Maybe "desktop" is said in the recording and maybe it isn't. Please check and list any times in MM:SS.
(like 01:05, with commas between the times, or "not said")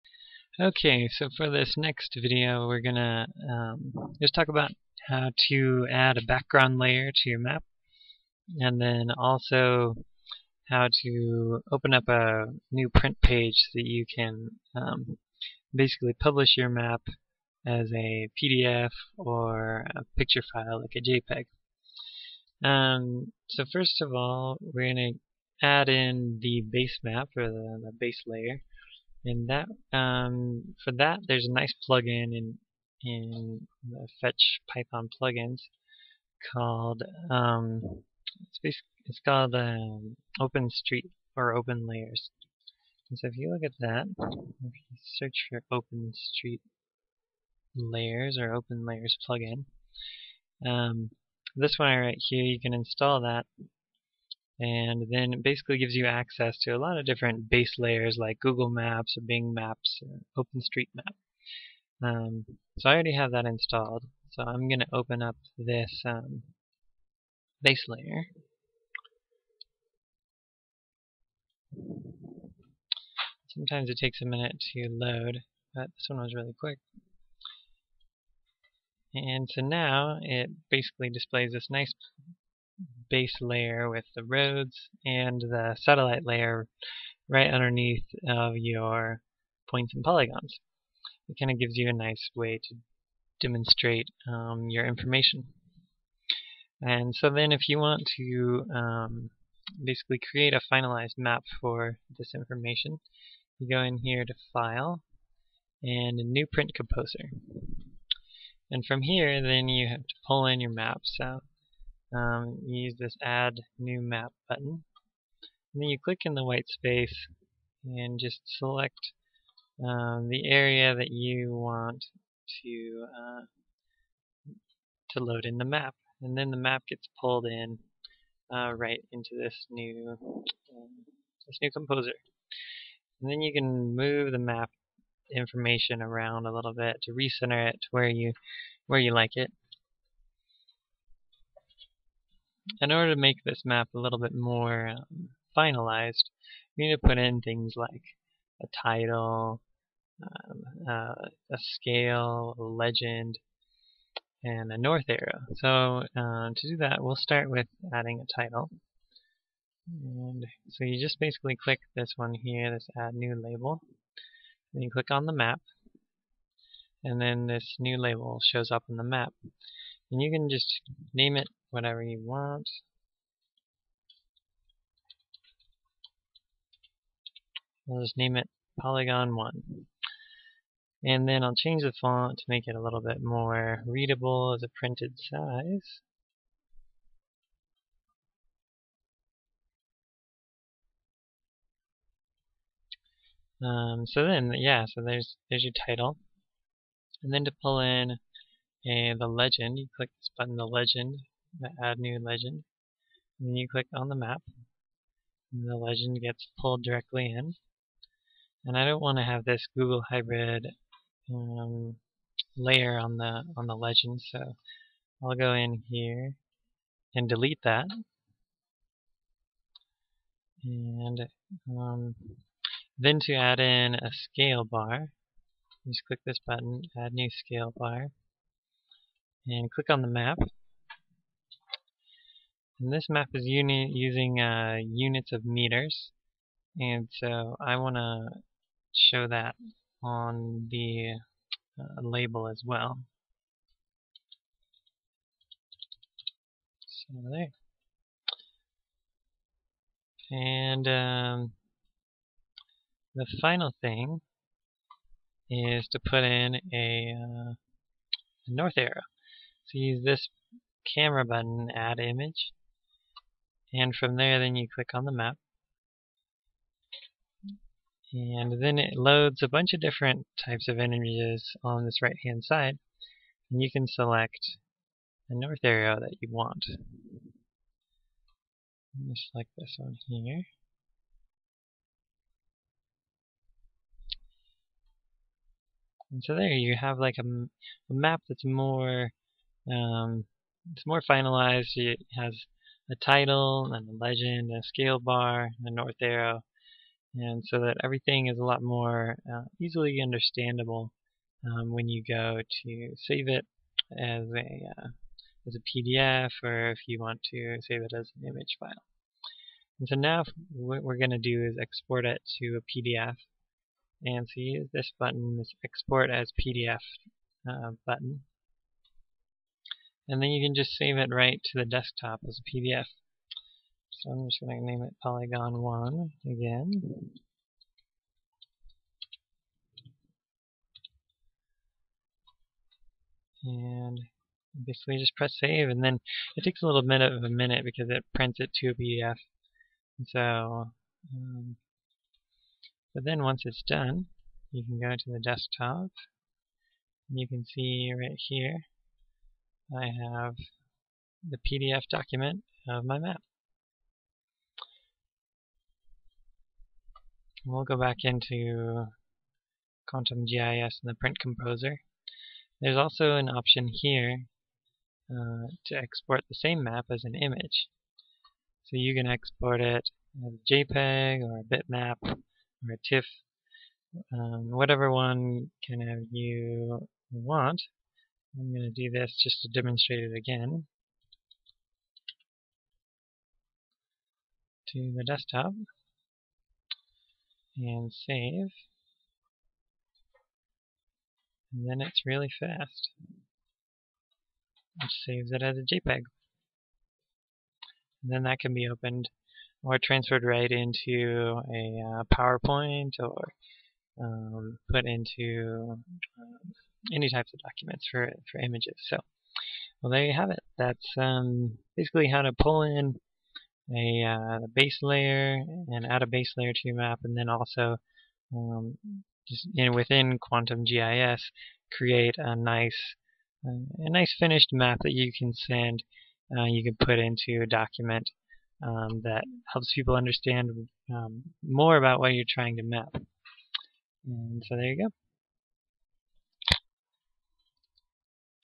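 05:21, 05:45, 06:25.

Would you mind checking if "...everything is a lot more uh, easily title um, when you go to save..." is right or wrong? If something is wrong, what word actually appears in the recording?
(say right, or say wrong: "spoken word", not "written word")
wrong: "understandable", not "title".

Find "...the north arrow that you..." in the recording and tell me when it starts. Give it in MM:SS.
04:35.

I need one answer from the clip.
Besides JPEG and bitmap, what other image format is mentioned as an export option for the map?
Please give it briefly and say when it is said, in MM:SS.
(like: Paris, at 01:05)
TIFF, at 06:12.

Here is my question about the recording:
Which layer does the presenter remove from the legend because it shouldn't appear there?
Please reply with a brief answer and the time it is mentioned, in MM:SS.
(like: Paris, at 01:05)
Google Hybrid, at 03:29.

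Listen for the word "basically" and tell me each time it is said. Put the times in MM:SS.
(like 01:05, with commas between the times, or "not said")
00:15, 00:55, 01:20, 01:39, 02:41, 05:34, 06:51.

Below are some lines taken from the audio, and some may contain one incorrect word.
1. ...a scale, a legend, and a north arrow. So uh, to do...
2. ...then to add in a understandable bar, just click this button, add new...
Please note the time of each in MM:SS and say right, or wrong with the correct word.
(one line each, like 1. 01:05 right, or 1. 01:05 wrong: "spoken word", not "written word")
1. 02:31 right
2. 03:42 wrong: "scale", not "understandable".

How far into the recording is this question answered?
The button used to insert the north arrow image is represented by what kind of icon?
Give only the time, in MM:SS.
04:20.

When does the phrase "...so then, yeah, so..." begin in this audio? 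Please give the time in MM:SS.
03:14.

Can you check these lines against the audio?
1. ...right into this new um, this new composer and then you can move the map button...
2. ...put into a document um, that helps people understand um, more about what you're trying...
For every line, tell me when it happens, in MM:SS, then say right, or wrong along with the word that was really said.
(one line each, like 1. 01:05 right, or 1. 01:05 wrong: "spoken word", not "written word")
1. 02:08 wrong: "information", not "button"
2. 07:06 right.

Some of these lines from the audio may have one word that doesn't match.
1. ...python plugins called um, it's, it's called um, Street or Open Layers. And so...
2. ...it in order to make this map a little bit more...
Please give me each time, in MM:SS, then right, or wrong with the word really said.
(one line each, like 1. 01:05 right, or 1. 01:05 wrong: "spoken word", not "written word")
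1. 00:34 right
2. 02:19 right.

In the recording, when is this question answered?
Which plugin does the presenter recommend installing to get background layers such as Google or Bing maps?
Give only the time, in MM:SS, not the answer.
00:48.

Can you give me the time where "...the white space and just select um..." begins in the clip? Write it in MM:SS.
01:56.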